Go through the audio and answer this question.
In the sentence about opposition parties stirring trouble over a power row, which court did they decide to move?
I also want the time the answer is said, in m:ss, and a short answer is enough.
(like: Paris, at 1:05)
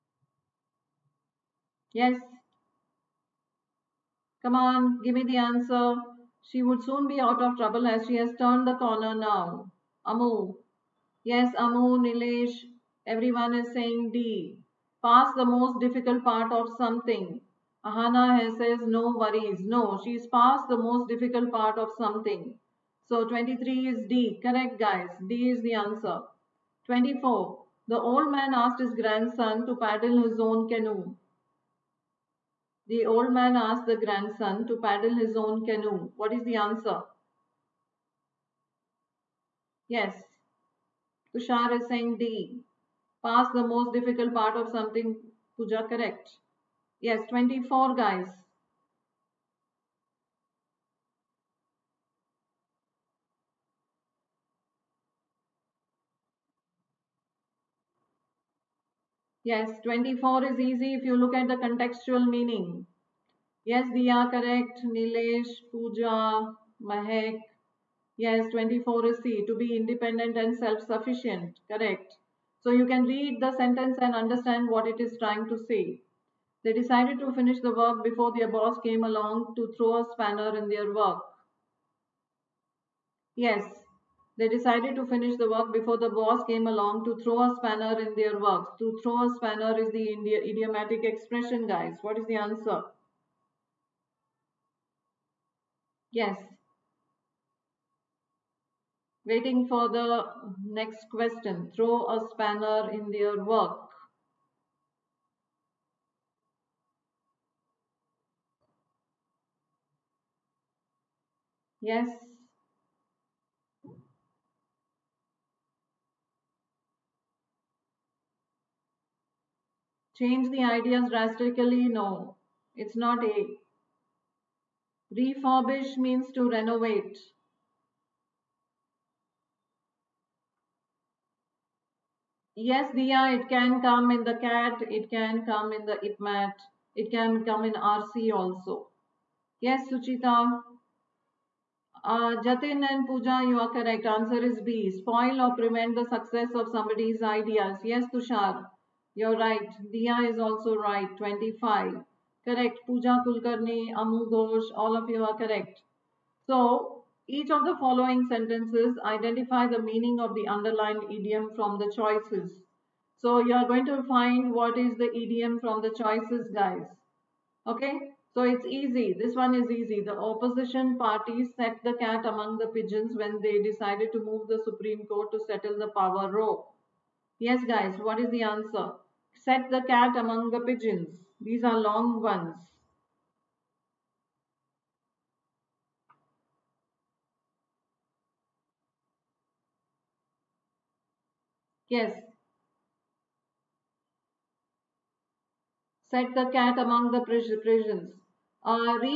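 Supreme Court, at 2:54.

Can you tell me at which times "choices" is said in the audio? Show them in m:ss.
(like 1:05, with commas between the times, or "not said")
2:41, 2:45.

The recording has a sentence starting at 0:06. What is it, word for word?
She would soon be out of trouble as she has turned the corner now.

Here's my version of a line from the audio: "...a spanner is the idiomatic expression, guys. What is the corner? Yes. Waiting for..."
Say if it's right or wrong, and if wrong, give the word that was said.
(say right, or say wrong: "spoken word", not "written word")
wrong: "answer", not "corner".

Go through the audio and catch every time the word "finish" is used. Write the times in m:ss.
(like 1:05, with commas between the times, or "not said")
1:17, 1:25.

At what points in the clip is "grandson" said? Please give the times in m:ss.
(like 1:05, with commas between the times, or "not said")
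0:28, 0:33.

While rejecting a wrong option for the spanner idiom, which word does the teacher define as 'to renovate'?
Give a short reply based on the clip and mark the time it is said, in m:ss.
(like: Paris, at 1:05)
Refurbish, at 2:05.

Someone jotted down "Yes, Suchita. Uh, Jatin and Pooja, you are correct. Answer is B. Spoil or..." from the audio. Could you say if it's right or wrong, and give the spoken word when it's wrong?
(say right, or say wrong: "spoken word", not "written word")
right.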